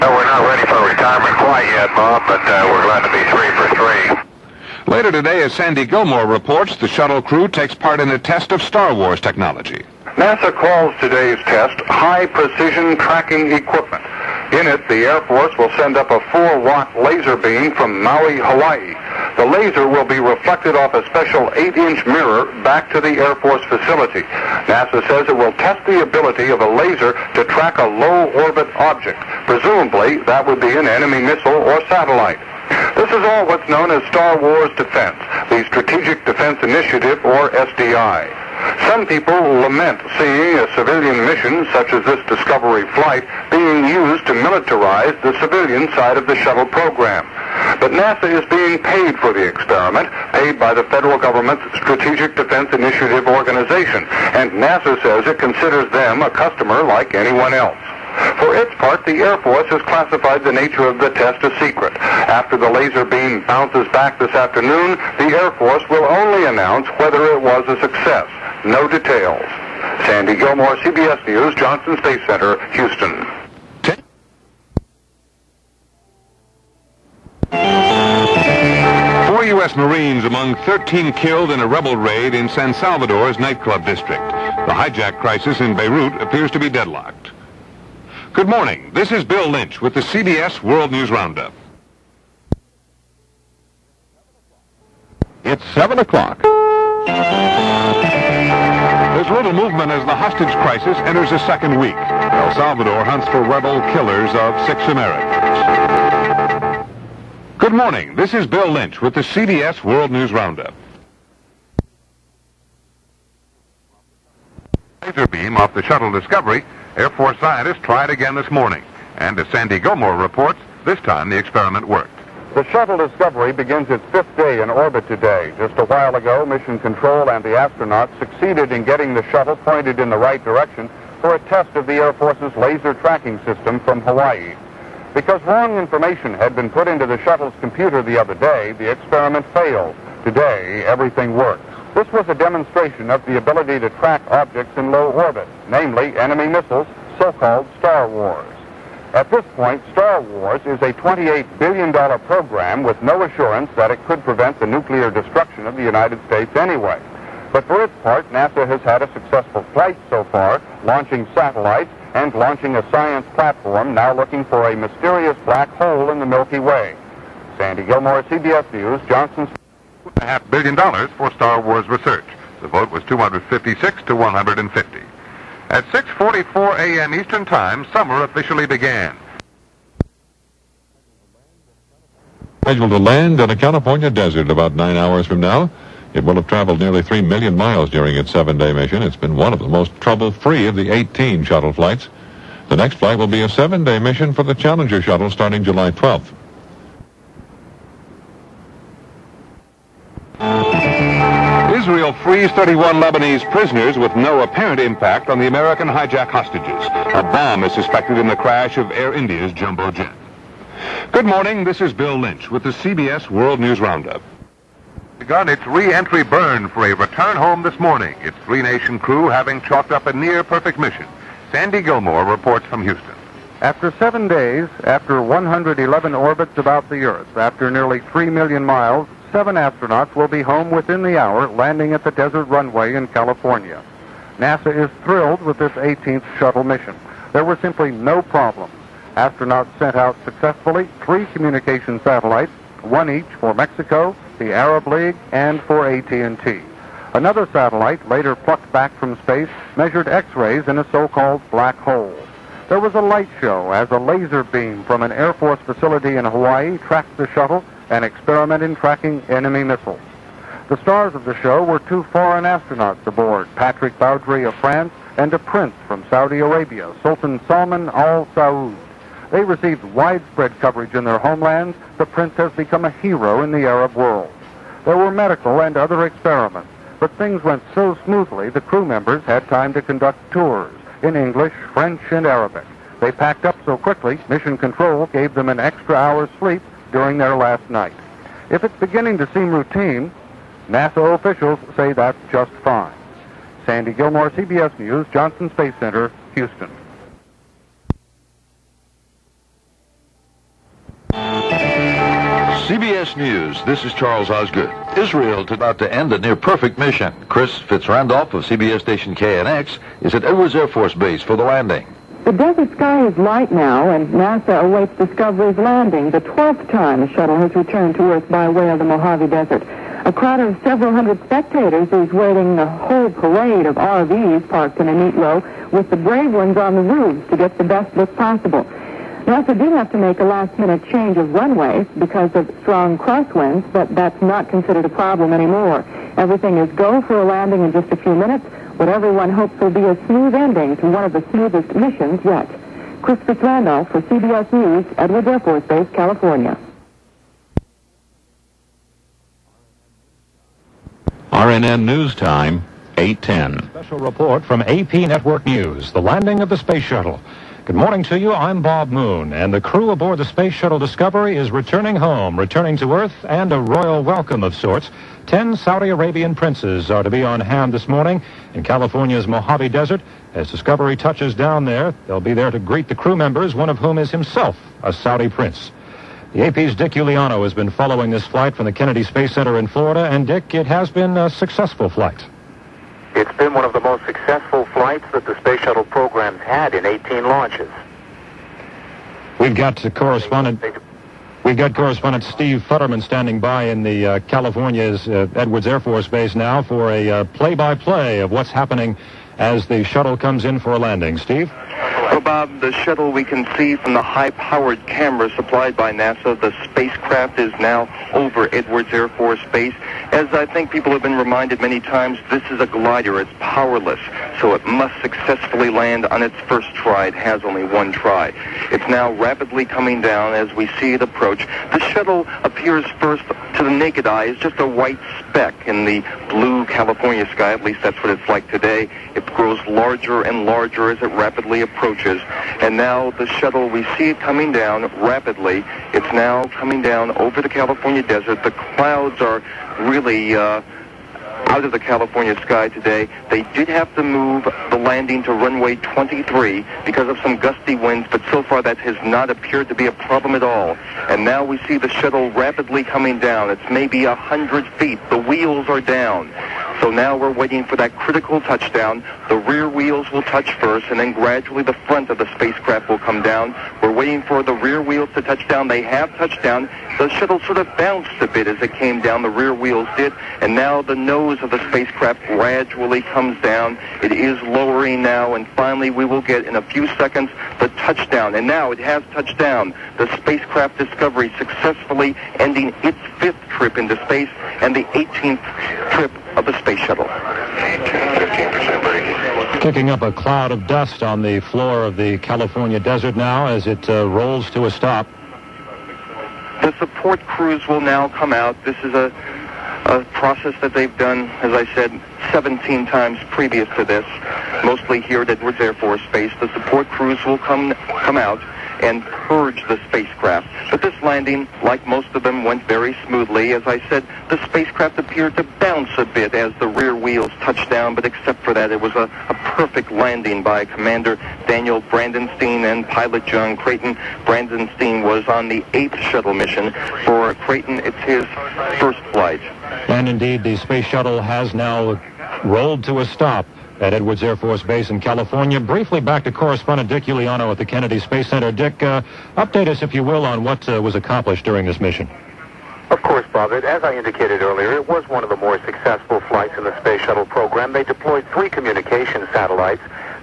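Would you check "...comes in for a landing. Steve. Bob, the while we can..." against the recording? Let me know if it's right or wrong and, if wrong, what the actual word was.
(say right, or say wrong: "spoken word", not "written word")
wrong: "shuttle", not "while".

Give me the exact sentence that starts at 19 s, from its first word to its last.
The laser will be reflected off a special 8-inch mirror back to the Air Force facility.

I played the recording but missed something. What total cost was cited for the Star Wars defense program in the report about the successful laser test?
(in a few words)
$28 billion.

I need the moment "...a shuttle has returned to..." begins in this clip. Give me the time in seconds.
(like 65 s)
317 s.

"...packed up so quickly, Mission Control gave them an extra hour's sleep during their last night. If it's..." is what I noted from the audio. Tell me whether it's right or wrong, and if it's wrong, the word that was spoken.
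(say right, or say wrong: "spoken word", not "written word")
right.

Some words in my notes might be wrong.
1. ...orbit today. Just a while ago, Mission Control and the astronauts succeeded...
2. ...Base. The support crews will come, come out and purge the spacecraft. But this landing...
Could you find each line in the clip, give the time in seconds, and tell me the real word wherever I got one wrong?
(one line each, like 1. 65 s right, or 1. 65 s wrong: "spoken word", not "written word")
1. 124 s right
2. 506 s right.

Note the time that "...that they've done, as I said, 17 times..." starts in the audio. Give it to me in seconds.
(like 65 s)
500 s.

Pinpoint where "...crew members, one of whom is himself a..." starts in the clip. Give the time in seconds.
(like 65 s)
372 s.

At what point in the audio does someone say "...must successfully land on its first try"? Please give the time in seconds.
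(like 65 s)
414 s.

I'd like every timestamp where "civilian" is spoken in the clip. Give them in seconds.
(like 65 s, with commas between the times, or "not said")
40 s, 45 s.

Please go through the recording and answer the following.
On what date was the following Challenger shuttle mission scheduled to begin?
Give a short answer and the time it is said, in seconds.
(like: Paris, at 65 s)
July 12, at 195 s.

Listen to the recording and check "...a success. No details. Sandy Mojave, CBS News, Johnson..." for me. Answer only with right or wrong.
wrong.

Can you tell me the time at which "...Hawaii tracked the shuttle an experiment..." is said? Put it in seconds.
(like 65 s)
256 s.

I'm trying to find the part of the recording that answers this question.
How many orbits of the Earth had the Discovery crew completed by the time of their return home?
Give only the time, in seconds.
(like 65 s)
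225 s.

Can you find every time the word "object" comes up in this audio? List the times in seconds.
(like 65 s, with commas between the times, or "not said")
28 s, 144 s.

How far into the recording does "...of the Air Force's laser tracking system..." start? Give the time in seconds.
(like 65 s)
131 s.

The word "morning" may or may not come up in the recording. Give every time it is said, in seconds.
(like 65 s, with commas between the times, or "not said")
88 s, 107 s, 118 s, 211 s, 217 s, 357 s, 367 s.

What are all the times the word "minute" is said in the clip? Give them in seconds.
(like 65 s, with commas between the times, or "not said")
330 s, 338 s.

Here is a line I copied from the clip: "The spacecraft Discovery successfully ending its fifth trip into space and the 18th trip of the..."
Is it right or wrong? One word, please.
right.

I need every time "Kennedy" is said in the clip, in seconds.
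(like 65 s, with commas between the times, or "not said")
378 s, 537 s.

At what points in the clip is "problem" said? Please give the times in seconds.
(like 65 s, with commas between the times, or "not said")
238 s, 334 s, 449 s.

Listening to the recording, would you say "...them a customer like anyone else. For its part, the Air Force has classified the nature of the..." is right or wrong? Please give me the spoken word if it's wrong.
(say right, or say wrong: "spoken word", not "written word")
right.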